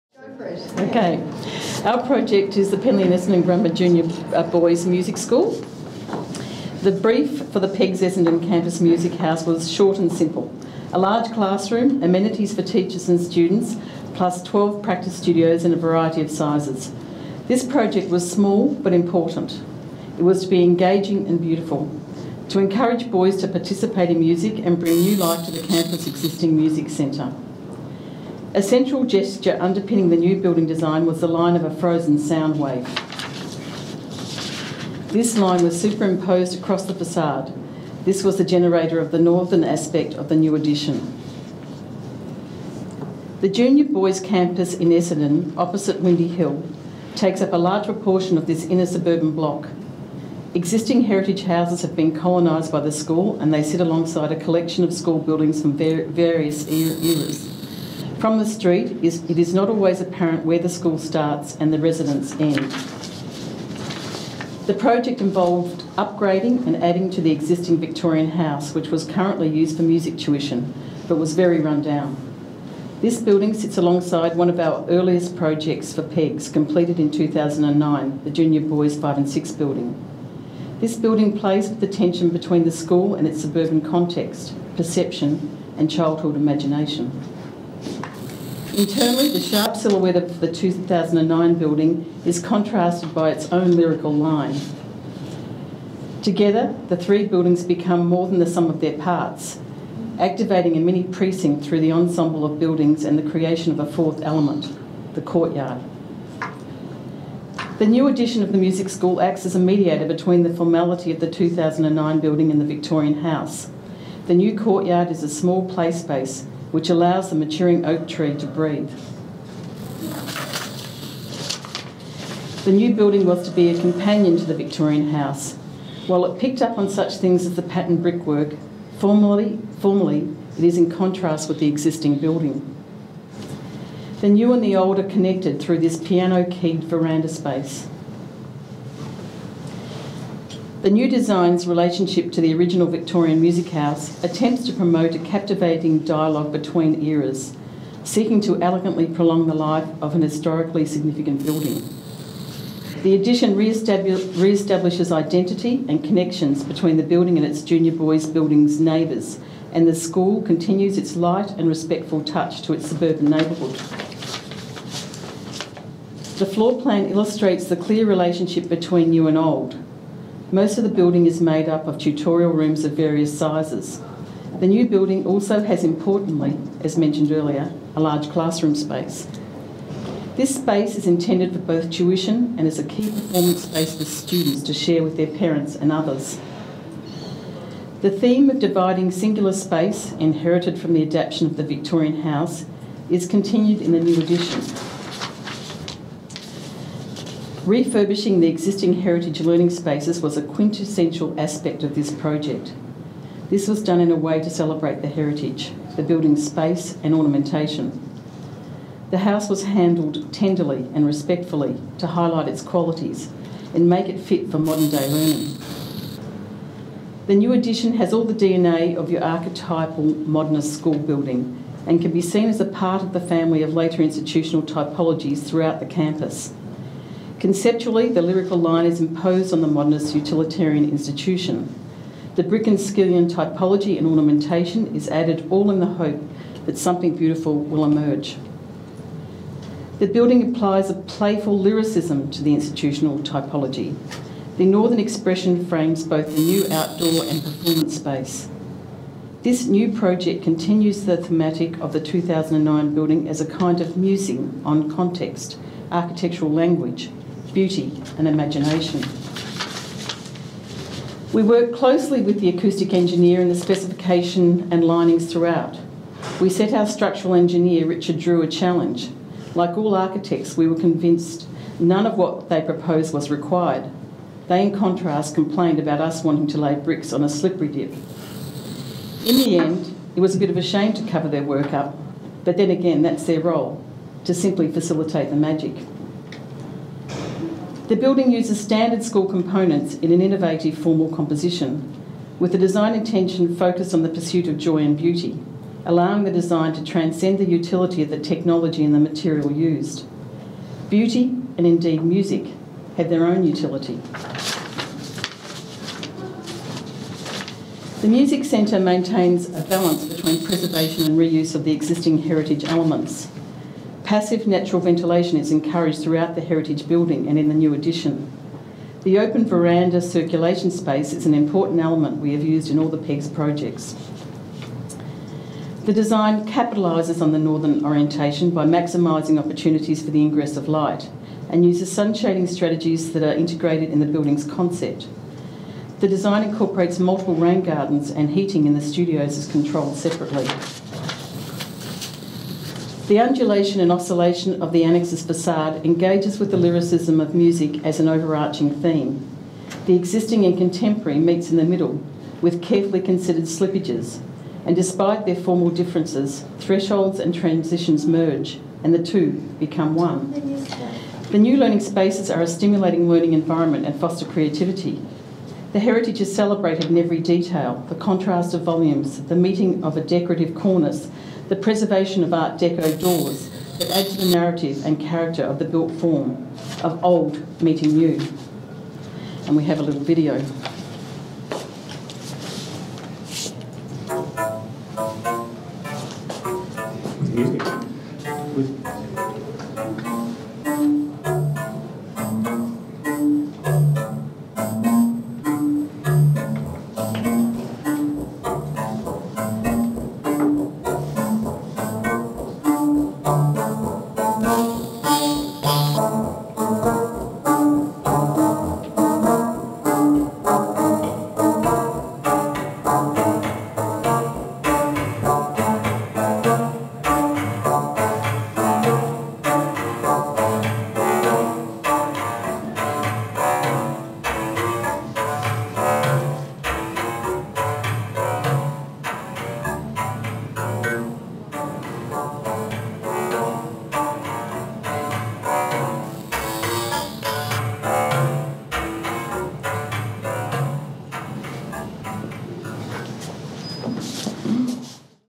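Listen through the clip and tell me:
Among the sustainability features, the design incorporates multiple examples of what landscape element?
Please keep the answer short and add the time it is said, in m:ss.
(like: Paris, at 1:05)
Rain gardens, at 5:37.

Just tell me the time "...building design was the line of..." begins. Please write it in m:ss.
0:30.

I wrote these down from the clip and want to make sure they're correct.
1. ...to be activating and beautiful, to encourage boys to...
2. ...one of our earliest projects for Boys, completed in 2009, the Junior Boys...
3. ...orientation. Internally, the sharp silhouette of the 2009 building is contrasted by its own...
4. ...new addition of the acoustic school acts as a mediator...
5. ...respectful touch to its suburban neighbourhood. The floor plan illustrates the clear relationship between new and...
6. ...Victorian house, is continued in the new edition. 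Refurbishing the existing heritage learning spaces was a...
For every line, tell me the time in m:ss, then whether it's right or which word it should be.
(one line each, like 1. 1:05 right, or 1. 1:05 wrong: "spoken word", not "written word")
1. 0:20 wrong: "engaging", not "activating"
2. 1:14 wrong: "PEGS", not "Boys"
3. 1:26 wrong: "imagination", not "orientation"
4. 1:47 wrong: "music", not "acoustic"
5. 2:41 right
6. 3:11 right.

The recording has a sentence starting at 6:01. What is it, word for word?
The new learning spaces are a stimulating learning environment and foster creativity.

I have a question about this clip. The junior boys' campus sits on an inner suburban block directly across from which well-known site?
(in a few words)
Windy Hill.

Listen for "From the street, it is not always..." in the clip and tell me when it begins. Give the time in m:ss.
0:58.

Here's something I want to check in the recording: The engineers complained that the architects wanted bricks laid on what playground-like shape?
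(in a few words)
A slippery dip.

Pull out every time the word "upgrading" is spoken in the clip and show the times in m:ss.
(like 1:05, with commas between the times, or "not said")
1:05.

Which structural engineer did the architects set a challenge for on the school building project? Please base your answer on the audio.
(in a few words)
Richard Drew.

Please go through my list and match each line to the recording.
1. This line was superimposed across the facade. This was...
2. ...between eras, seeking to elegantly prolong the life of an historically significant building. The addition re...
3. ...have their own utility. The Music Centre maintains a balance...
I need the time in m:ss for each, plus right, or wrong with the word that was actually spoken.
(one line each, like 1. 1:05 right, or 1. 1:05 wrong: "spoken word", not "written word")
1. 0:35 right
2. 2:26 right
3. 5:02 right.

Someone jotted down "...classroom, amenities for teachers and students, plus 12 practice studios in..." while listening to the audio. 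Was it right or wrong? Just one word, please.
right.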